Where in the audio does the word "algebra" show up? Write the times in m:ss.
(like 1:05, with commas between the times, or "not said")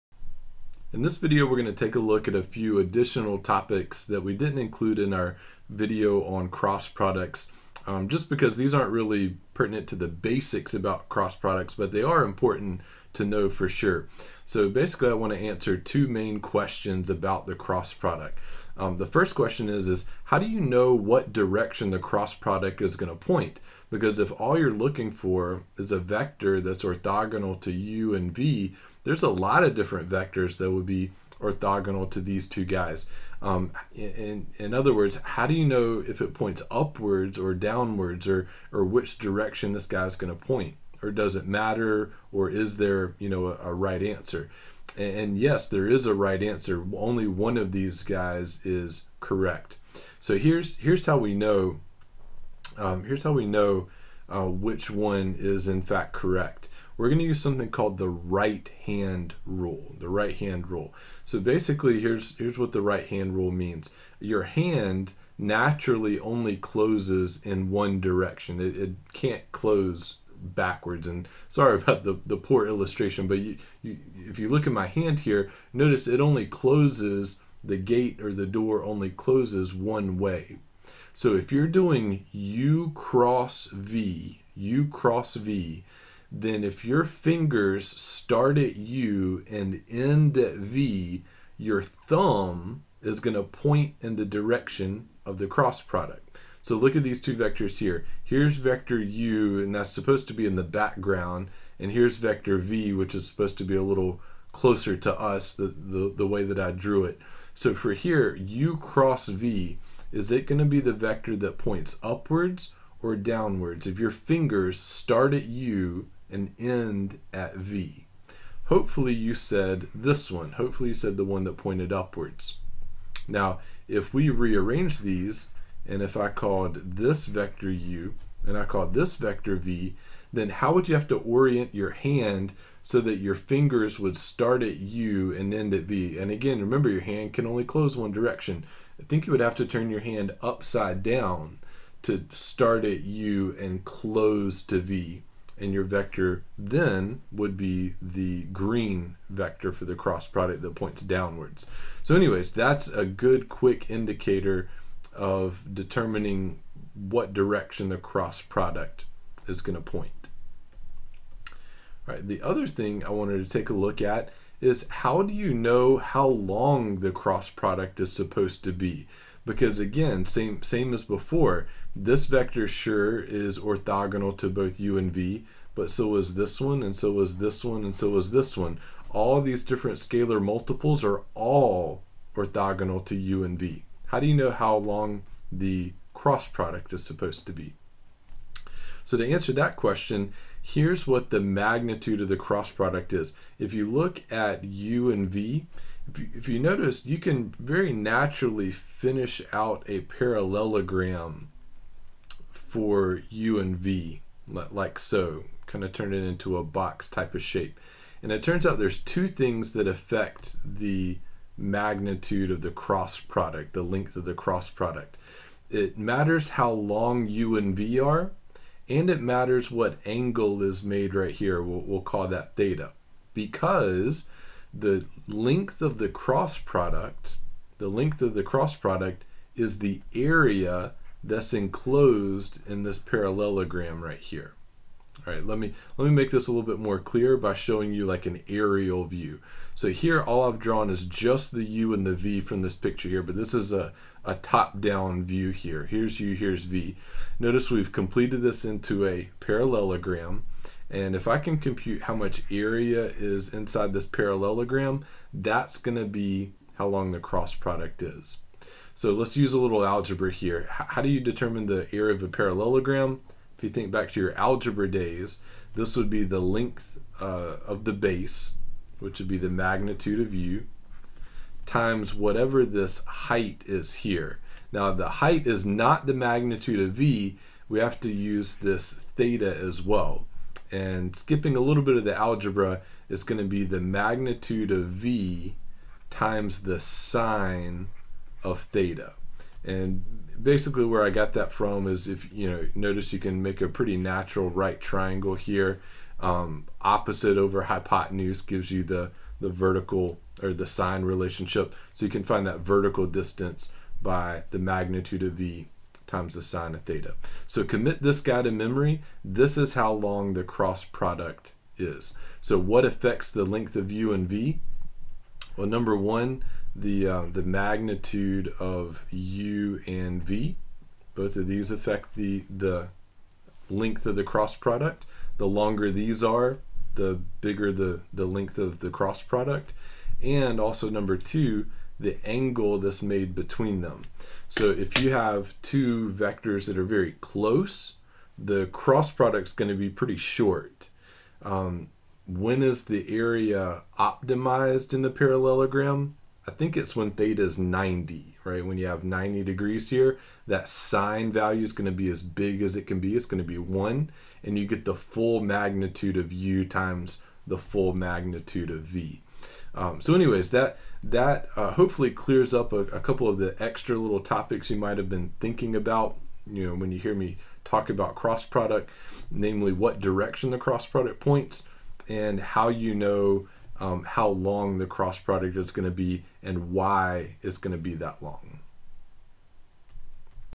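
4:19, 4:24, 4:42.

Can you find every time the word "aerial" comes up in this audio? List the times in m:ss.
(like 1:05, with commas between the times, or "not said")
3:58.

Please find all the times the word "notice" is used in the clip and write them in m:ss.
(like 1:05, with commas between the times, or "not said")
1:15, 3:16, 4:07, 4:52.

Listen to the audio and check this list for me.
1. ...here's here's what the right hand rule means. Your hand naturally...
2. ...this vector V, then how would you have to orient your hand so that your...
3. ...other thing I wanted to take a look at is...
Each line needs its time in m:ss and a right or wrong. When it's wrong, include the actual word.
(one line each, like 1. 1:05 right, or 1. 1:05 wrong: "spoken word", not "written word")
1. 1:01 right
2. 2:08 right
3. 2:42 right.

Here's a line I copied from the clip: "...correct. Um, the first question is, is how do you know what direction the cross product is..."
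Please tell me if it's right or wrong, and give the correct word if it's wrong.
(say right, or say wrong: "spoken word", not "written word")
wrong: "product", not "correct".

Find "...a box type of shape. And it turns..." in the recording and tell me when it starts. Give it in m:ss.
3:26.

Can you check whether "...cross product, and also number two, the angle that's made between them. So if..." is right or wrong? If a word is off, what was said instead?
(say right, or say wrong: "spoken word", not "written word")
right.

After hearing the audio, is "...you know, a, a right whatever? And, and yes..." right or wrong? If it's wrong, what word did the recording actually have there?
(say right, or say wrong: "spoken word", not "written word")
wrong: "answer", not "whatever".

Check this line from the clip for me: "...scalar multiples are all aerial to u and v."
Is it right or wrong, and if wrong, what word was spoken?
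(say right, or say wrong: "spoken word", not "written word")
wrong: "orthogonal", not "aerial".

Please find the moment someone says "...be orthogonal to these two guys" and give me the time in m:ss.
0:30.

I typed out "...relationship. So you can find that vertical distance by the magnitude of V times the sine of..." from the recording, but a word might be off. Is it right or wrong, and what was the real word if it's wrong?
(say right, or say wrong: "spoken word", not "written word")
right.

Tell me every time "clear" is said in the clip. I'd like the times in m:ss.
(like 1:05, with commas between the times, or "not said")
3:56, 6:02.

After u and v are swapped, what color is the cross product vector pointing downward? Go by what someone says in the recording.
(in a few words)
green.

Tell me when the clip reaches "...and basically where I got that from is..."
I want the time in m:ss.
4:49.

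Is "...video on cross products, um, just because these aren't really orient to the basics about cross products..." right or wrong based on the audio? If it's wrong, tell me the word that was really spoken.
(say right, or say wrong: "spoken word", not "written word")
wrong: "pertinent", not "orient".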